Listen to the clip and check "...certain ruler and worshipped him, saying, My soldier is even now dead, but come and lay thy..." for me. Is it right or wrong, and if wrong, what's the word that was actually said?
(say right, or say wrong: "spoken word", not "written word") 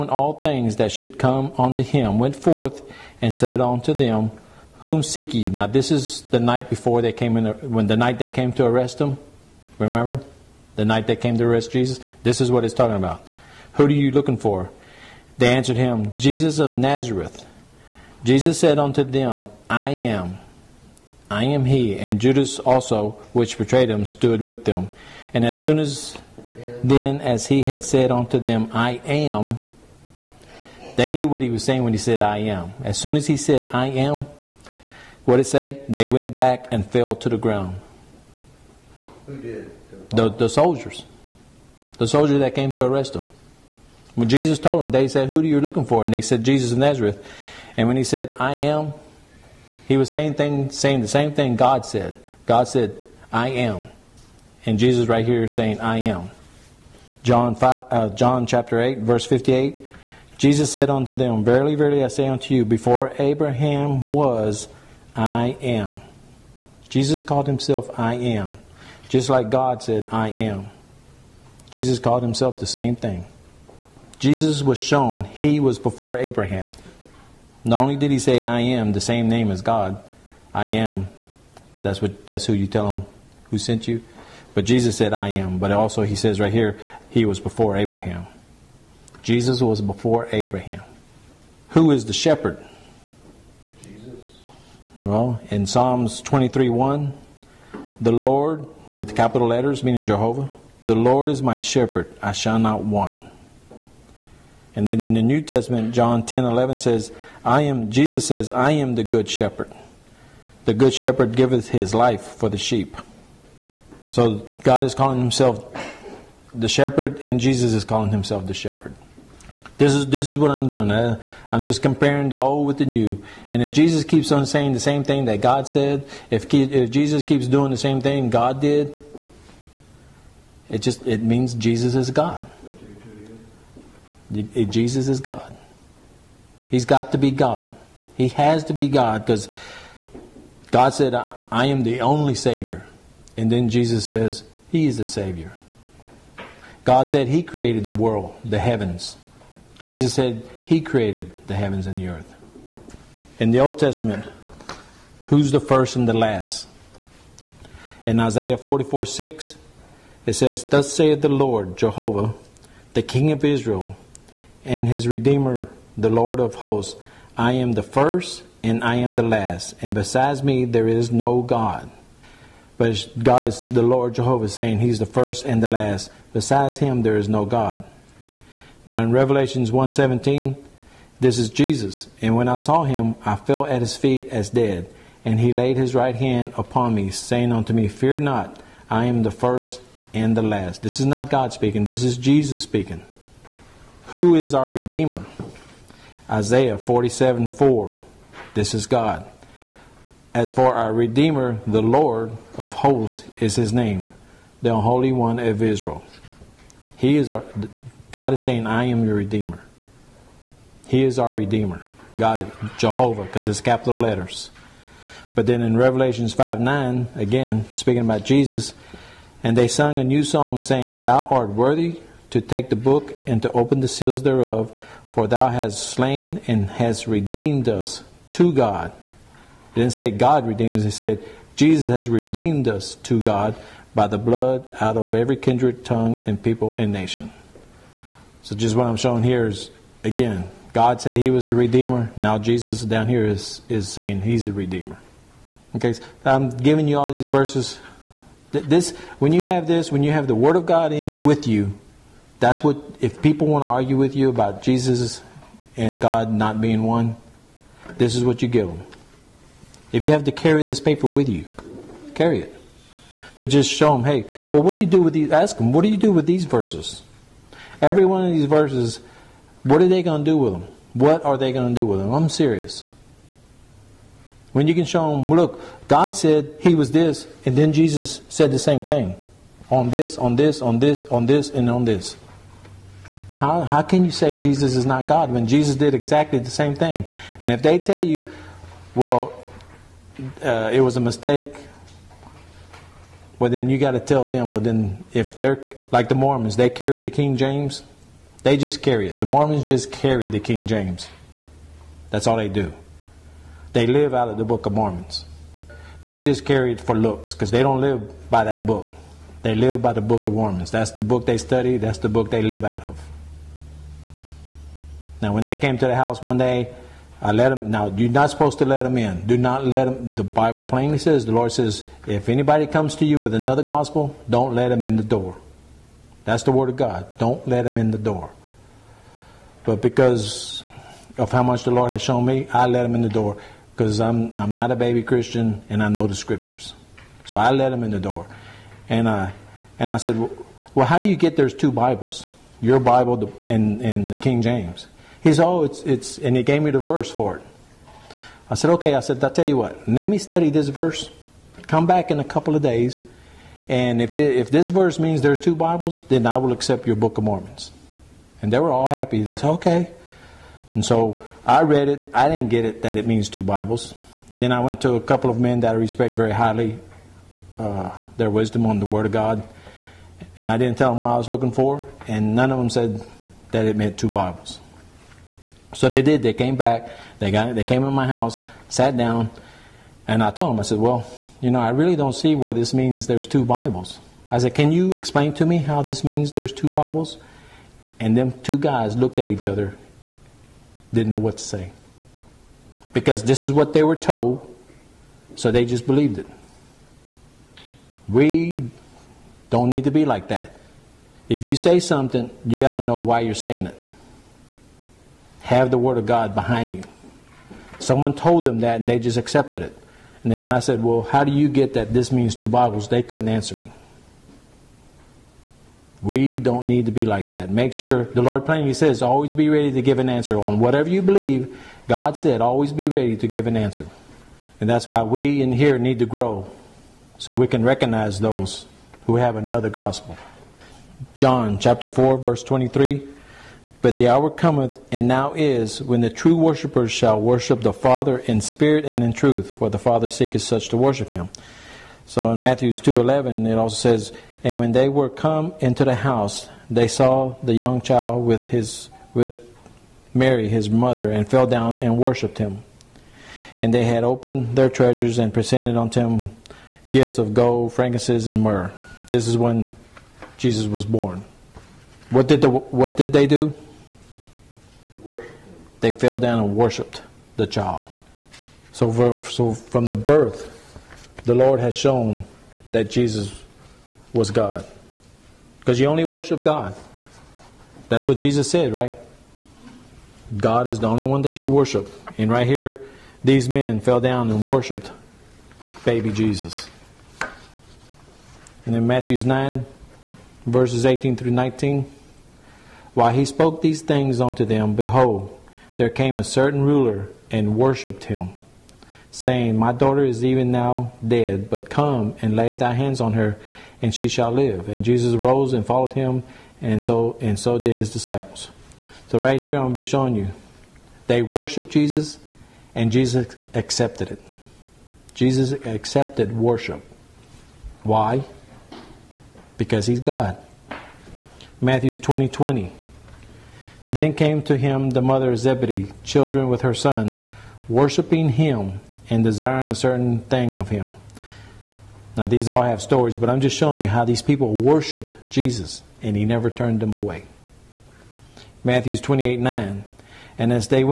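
wrong: "daughter", not "soldier".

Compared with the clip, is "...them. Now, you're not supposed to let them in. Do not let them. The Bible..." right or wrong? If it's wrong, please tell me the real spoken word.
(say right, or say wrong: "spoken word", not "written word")
right.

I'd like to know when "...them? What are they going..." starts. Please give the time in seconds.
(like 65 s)
270 s.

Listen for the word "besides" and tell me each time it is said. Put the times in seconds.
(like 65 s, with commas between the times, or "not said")
169 s, 176 s.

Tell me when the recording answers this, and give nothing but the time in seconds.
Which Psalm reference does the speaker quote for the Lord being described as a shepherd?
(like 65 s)
95 s.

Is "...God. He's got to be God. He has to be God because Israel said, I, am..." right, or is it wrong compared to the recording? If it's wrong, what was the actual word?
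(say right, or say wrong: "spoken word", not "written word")
wrong: "God", not "Israel".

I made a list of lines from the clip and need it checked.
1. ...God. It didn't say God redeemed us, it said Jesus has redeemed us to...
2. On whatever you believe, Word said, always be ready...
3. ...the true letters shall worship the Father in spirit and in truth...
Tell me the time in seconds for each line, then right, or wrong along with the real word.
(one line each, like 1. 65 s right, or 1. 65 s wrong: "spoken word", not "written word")
1. 228 s right
2. 420 s wrong: "God", not "Word"
3. 435 s wrong: "worshippers", not "letters".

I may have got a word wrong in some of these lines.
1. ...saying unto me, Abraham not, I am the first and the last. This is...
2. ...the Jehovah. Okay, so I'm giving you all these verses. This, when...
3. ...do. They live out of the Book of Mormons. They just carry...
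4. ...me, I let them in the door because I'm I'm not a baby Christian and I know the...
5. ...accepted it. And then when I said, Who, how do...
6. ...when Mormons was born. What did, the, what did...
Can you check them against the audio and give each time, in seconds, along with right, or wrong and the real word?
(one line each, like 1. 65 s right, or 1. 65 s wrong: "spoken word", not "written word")
1. 187 s wrong: "Fear", not "Abraham"
2. 244 s wrong: "Redeemer", not "Jehovah"
3. 302 s right
4. 332 s right
5. 409 s wrong: "Well", not "Who"
6. 459 s wrong: "Jesus", not "Mormons".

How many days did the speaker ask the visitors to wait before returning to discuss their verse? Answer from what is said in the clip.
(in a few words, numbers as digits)
a couple of days.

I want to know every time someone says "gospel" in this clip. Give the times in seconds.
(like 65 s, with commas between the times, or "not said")
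323 s, 429 s.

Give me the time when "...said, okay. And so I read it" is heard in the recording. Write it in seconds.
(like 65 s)
359 s.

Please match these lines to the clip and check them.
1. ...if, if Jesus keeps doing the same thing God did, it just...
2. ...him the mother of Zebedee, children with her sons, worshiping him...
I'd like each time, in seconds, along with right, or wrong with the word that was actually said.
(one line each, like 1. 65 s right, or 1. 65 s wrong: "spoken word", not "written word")
1. 126 s right
2. 524 s right.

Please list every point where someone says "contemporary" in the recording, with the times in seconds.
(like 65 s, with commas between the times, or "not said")
not said.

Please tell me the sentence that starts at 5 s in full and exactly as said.
Now, this is the night before they came in, when the night they came to arrest him.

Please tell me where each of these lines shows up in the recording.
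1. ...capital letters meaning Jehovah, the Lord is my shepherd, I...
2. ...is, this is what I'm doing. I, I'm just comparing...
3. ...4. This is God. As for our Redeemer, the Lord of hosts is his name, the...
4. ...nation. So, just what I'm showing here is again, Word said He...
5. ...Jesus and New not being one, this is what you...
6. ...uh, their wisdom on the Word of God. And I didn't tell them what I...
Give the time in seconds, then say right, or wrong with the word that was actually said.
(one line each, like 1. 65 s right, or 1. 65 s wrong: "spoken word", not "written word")
1. 99 s right
2. 119 s right
3. 197 s right
4. 236 s wrong: "God", not "Word"
5. 254 s wrong: "God", not "New"
6. 367 s right.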